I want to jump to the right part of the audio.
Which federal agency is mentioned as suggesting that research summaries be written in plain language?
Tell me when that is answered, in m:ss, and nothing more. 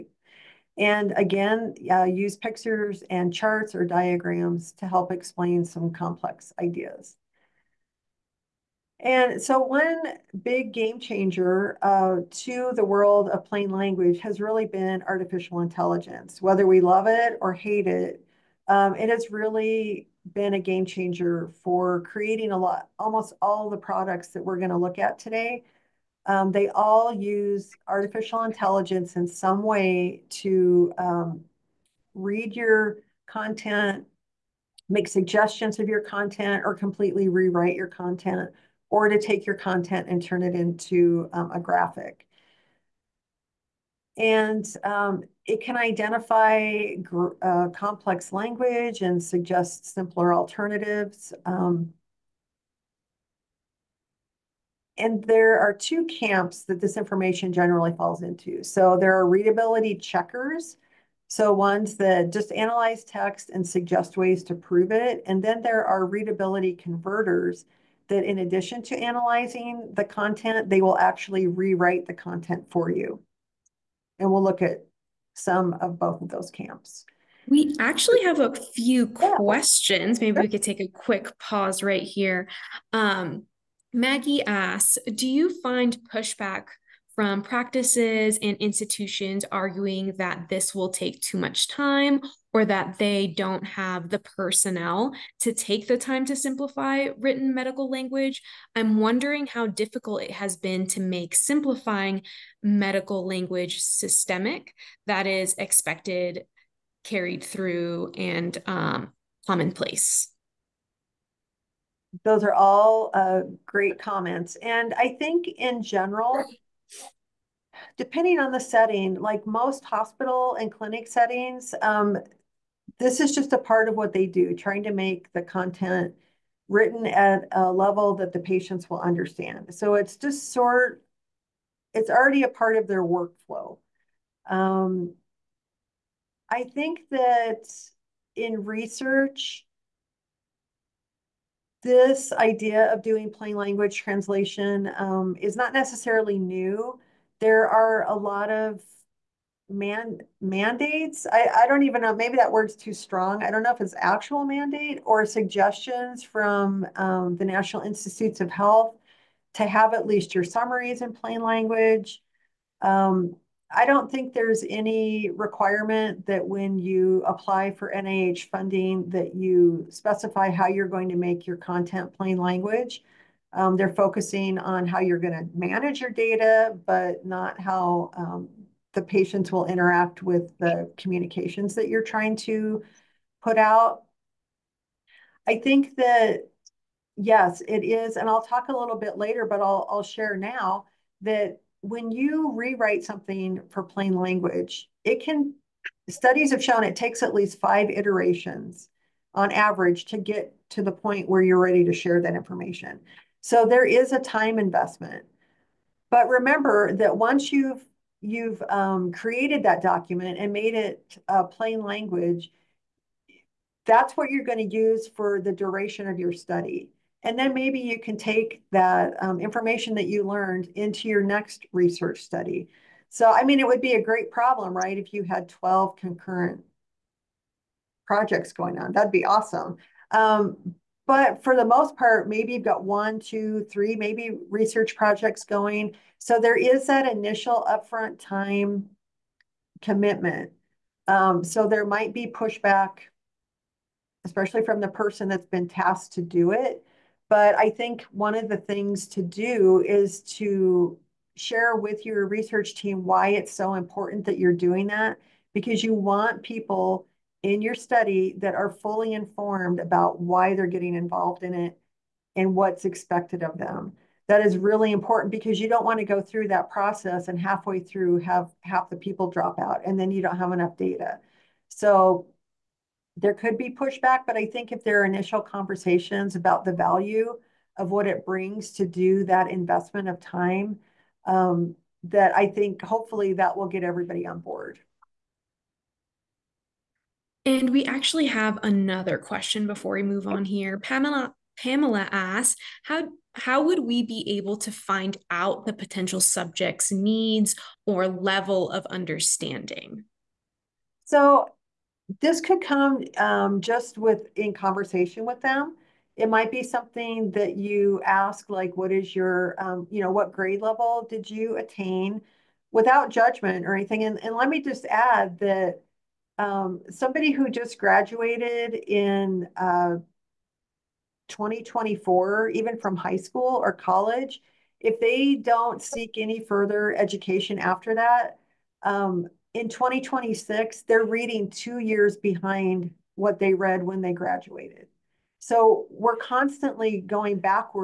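2:37.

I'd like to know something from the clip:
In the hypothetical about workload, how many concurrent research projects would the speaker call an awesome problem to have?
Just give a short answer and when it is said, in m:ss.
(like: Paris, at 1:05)
12, at 3:45.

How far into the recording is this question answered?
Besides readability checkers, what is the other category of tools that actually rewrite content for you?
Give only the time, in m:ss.
1:06.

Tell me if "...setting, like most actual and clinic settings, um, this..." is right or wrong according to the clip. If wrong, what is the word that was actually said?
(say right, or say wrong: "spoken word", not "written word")
wrong: "hospital", not "actual".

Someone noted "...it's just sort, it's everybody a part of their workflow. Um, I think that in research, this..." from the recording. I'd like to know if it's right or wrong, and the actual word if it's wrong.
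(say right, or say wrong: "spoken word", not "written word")
wrong: "already", not "everybody".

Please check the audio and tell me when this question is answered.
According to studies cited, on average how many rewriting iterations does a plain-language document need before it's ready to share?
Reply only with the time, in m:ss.
3:17.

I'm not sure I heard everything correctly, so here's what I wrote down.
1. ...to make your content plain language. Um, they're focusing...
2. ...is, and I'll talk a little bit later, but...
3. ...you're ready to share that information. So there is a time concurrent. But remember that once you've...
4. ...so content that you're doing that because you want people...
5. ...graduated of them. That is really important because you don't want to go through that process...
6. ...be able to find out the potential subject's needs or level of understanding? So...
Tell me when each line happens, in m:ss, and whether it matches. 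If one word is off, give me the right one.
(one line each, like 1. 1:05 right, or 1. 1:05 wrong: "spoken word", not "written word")
1. 2:51 right
2. 3:07 right
3. 3:21 wrong: "investment", not "concurrent"
4. 4:13 wrong: "important", not "content"
5. 4:22 wrong: "expected", not "graduated"
6. 4:54 right.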